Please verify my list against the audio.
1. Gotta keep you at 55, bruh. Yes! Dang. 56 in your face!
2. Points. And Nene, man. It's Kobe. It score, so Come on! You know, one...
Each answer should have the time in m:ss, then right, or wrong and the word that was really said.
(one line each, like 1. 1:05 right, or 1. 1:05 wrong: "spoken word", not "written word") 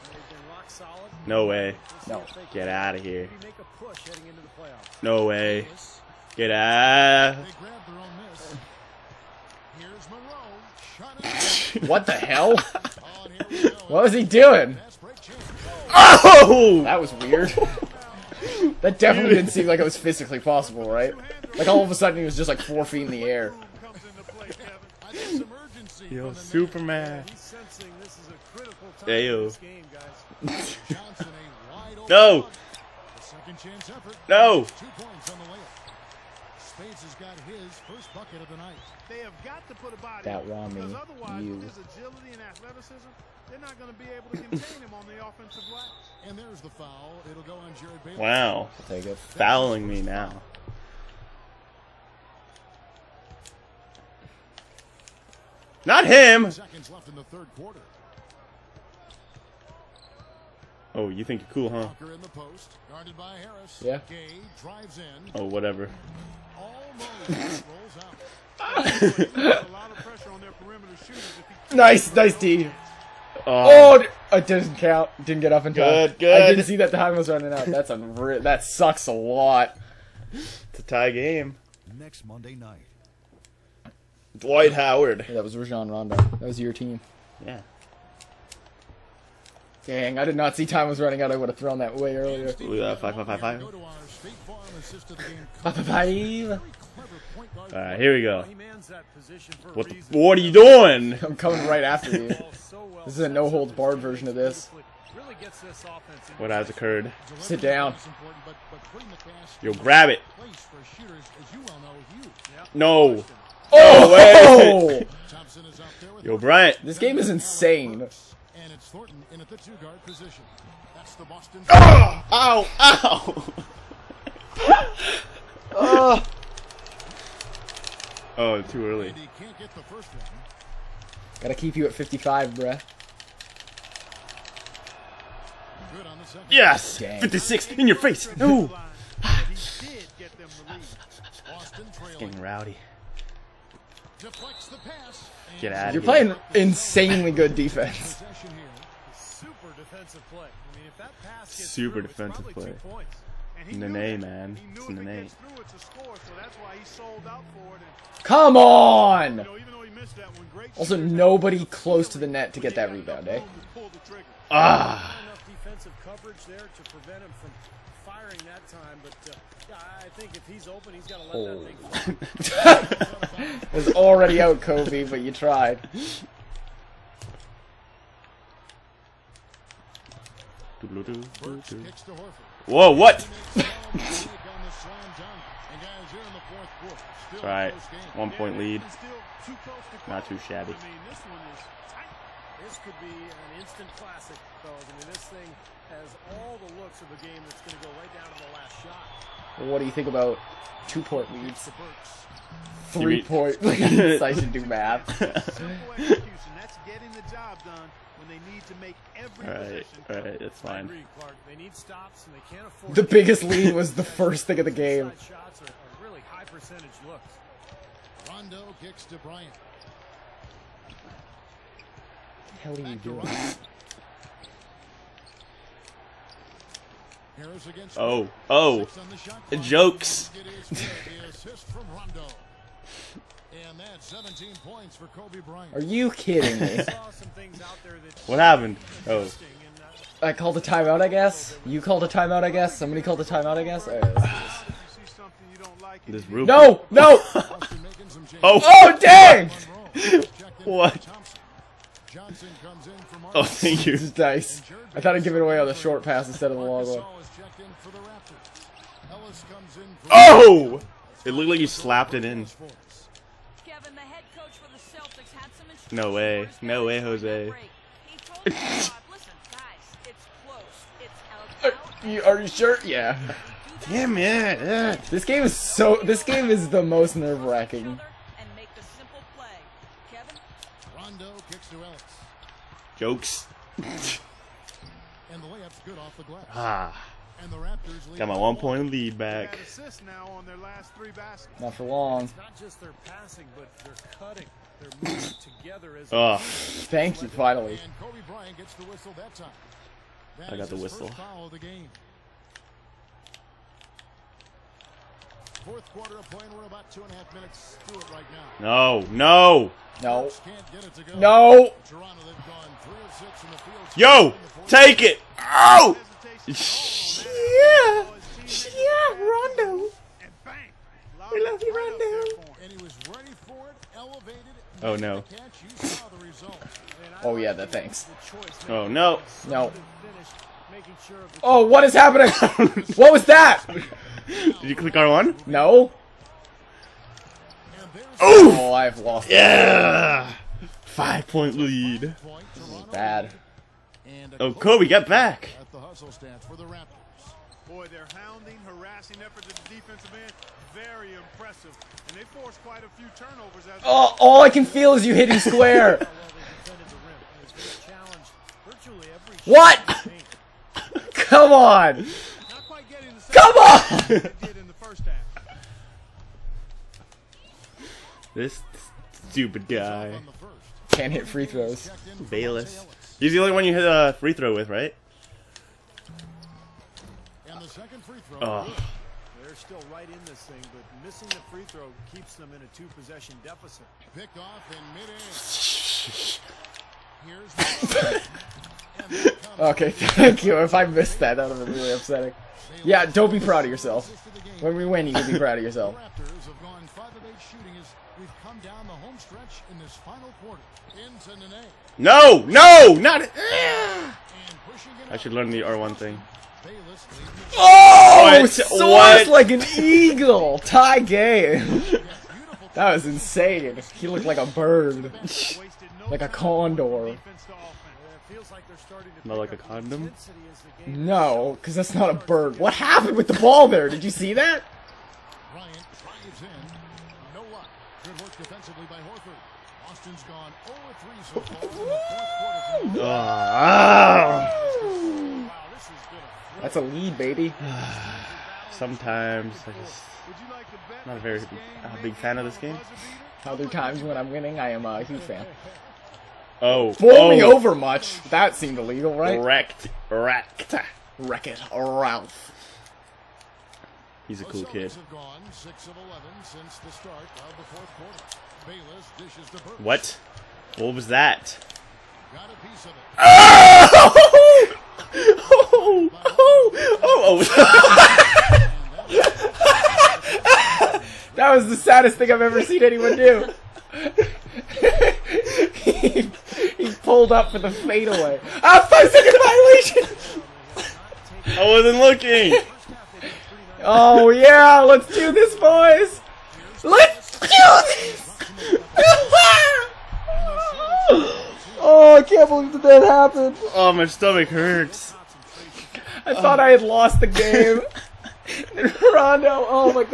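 1. 2:11 right
2. 2:32 wrong: "Nene", not "Kobe".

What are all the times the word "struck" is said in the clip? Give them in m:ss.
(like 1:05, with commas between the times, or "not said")
not said.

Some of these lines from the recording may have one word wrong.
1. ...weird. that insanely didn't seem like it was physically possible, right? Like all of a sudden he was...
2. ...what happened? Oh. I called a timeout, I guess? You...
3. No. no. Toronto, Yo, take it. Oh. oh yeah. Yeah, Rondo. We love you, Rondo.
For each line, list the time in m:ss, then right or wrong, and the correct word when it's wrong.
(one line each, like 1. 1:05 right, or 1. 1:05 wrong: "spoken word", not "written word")
1. 0:17 wrong: "definitely", not "insanely"
2. 3:58 right
3. 5:10 right.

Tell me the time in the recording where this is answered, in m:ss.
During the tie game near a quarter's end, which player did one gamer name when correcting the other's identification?
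1:25.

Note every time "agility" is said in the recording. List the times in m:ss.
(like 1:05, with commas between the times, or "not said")
0:41.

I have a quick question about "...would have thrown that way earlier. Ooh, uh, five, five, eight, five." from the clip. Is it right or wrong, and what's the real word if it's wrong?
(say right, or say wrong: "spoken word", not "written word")
wrong: "five", not "eight".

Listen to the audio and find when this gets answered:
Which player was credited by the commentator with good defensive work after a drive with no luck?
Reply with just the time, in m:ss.
7:09.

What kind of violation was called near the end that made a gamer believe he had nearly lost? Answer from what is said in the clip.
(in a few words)
Five second violation.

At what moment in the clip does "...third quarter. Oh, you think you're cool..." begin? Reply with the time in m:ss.
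0:57.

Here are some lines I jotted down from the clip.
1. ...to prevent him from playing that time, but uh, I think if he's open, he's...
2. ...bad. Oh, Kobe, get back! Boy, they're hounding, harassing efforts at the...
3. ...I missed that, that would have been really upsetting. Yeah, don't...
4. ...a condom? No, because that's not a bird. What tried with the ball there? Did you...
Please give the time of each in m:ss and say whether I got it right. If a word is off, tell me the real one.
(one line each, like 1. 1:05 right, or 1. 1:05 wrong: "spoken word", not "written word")
1. 2:46 wrong: "firing", not "playing"
2. 5:42 right
3. 6:30 right
4. 6:59 wrong: "happened", not "tried".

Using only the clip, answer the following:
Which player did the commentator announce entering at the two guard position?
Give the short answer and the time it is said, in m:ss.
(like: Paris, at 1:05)
Thornton, at 1:58.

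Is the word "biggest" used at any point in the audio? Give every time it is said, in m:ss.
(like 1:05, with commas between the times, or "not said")
3:33.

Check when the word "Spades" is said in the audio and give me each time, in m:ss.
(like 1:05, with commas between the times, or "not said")
0:36.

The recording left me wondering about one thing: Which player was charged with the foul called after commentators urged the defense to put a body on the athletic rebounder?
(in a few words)
Jared Bailey.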